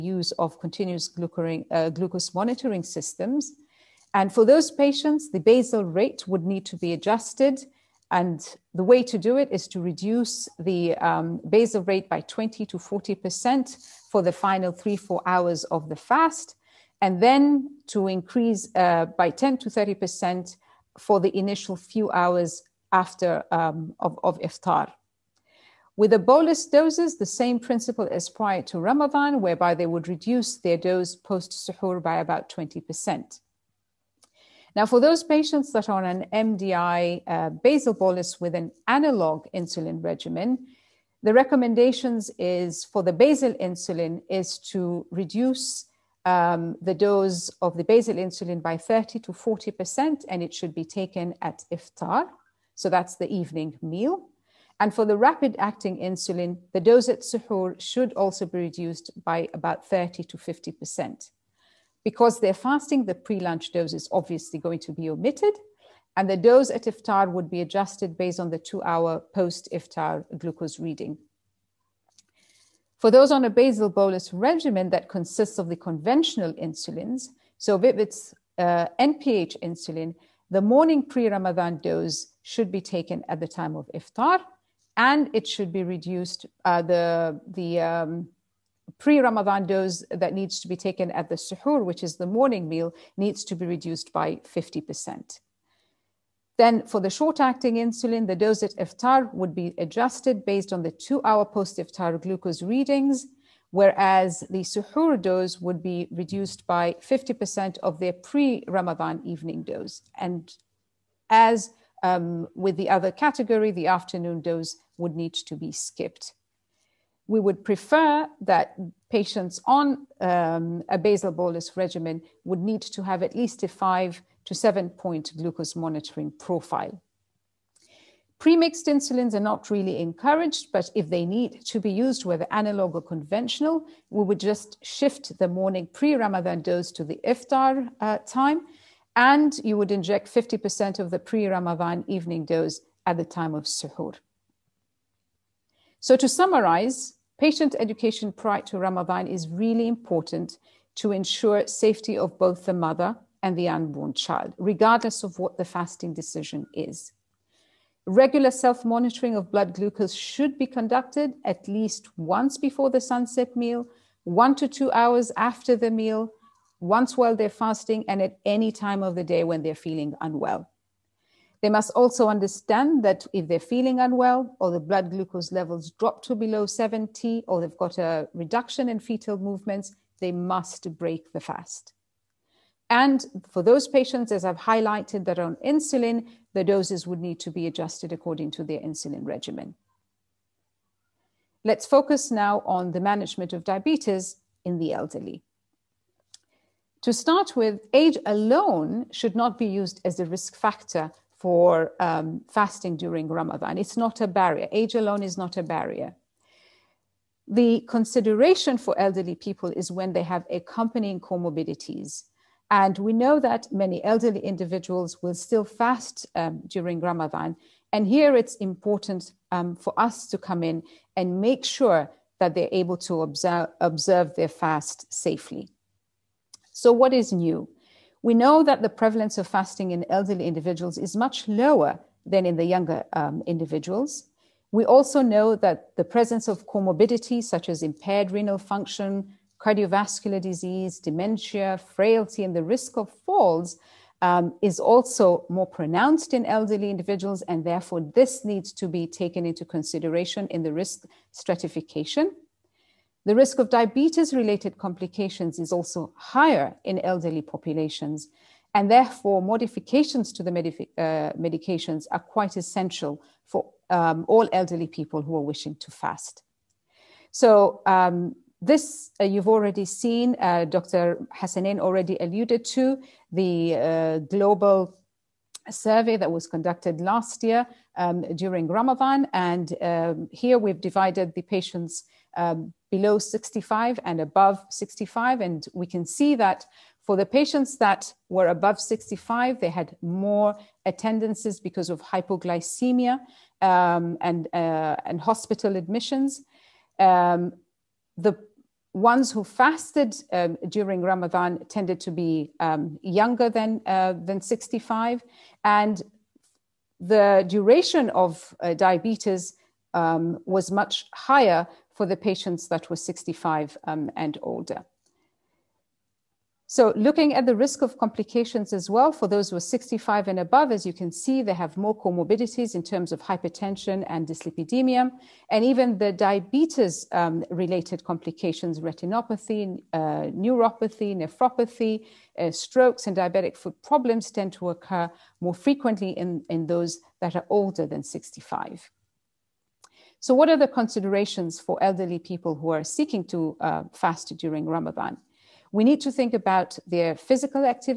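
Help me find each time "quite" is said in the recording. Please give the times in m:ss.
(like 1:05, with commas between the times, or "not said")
4:22.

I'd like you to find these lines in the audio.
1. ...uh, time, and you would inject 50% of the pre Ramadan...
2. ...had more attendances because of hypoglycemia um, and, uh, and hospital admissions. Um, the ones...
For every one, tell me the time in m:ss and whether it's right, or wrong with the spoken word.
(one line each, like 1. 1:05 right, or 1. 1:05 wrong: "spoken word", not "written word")
1. 2:17 right
2. 4:49 right.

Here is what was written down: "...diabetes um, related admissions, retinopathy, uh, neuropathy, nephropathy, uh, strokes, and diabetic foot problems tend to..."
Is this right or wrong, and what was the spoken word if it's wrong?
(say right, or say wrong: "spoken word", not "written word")
wrong: "complications", not "admissions".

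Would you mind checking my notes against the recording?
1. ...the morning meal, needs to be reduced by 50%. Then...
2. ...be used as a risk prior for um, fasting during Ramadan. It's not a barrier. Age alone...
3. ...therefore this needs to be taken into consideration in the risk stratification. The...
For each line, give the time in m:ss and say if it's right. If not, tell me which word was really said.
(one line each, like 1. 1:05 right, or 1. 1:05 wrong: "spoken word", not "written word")
1. 1:32 right
2. 3:19 wrong: "factor", not "prior"
3. 4:07 right.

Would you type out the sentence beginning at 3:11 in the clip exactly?
Let's focus now on the management of diabetes in the elderly.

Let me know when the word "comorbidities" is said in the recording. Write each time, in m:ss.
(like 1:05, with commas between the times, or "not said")
3:31, 3:56, 5:22.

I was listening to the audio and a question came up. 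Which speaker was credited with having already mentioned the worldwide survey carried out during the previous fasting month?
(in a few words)
Dr. Hassanein.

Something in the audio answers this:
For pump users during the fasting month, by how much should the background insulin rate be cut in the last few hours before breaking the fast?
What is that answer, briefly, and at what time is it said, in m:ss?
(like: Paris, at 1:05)
20 to 40%, at 0:12.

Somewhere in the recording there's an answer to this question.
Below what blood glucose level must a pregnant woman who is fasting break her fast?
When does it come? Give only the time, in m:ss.
2:56.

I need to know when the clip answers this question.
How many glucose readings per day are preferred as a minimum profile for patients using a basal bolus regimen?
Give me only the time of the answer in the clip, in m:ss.
2:03.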